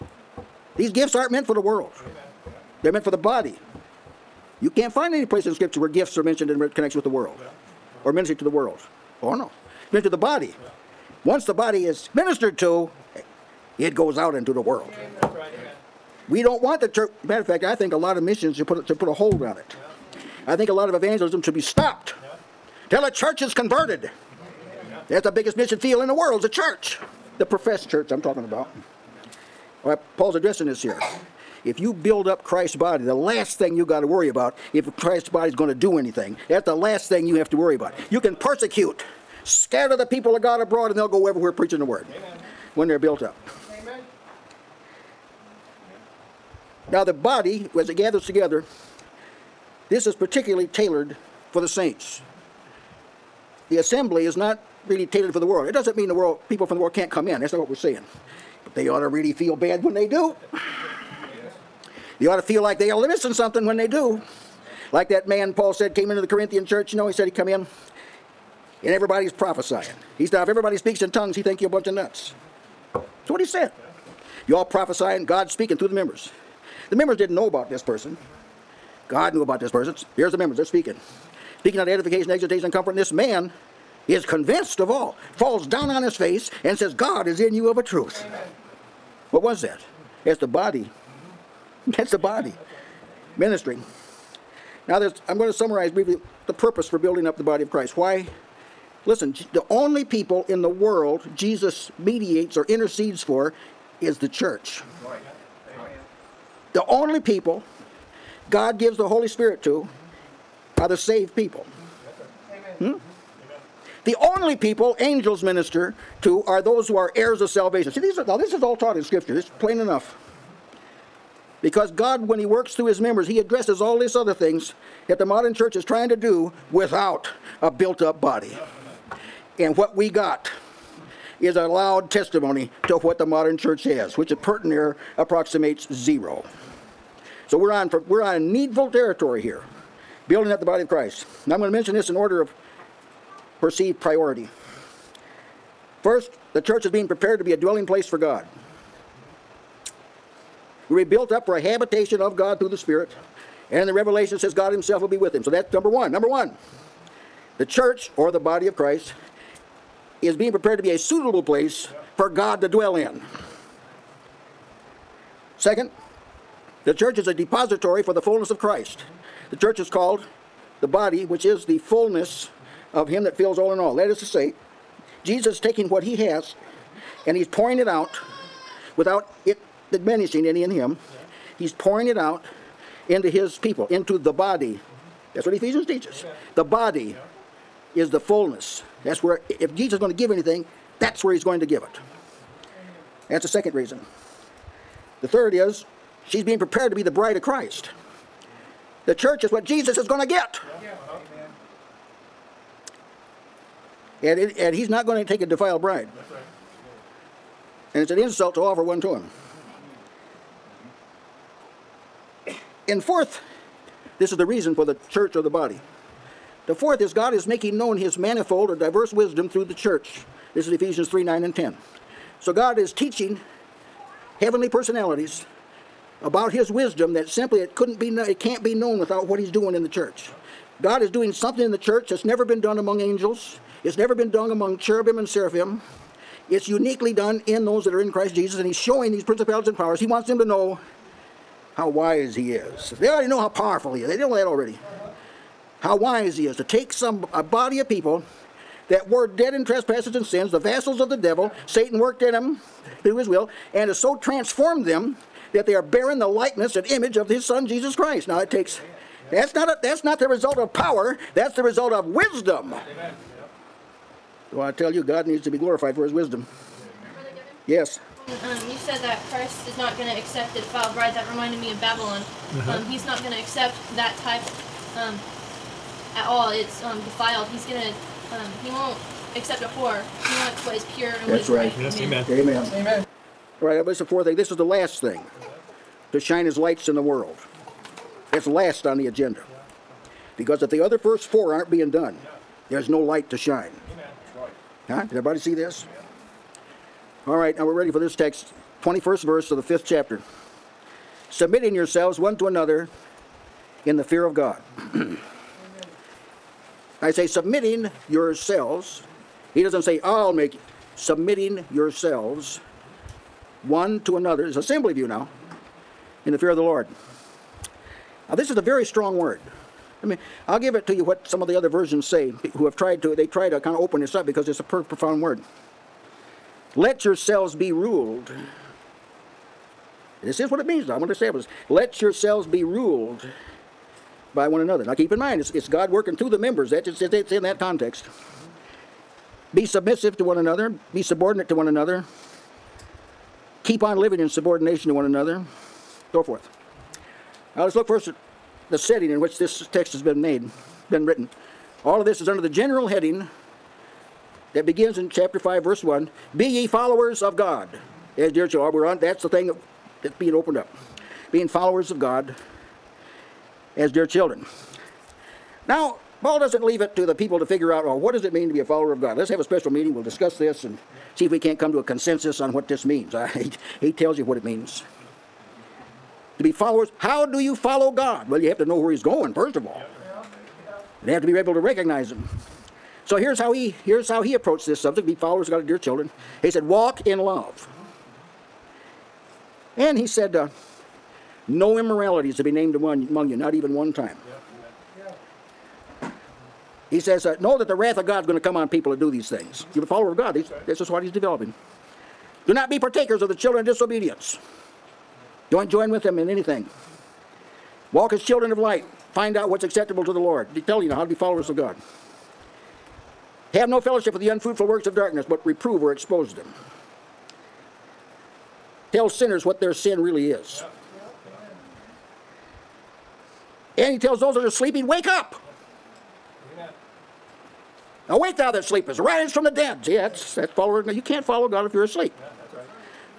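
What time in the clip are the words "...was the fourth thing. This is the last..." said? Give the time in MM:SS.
04:43.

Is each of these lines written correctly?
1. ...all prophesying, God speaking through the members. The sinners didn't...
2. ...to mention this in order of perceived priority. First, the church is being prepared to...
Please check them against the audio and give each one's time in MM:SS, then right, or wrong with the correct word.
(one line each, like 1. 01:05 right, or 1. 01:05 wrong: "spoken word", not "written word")
1. 01:14 wrong: "members", not "sinners"
2. 02:21 right.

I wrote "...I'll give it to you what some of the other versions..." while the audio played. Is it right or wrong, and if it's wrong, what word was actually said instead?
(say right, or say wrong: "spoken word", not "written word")
right.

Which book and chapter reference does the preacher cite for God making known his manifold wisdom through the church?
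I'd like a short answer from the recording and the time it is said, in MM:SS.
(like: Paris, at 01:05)
Ephesians 3:9-10, at 03:40.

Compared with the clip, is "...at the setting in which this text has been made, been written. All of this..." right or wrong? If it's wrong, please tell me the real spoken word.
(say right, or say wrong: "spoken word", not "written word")
right.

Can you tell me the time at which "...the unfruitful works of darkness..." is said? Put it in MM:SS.
06:54.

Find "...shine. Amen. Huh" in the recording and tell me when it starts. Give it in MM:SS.
04:53.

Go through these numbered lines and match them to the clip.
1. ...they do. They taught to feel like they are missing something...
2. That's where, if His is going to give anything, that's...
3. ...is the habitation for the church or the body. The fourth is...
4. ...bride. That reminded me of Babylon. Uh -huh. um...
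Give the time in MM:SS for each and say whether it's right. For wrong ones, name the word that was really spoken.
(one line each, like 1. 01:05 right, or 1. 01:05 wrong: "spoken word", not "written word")
1. 00:59 wrong: "ought", not "taught"
2. 03:09 wrong: "Jesus", not "His"
3. 03:34 wrong: "reason", not "habitation"
4. 04:30 right.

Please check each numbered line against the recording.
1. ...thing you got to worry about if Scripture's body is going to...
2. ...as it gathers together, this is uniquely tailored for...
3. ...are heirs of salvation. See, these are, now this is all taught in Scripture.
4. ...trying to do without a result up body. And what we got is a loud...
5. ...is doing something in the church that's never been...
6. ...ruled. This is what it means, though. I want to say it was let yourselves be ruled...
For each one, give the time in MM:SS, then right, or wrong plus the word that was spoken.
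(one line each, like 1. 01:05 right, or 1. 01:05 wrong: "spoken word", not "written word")
1. 00:33 wrong: "Christ", not "Scripture"
2. 00:47 wrong: "particularly", not "uniquely"
3. 01:56 right
4. 02:05 wrong: "built", not "result"
5. 03:51 right
6. 05:27 right.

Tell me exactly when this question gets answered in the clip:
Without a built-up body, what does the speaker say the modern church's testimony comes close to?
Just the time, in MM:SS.
02:15.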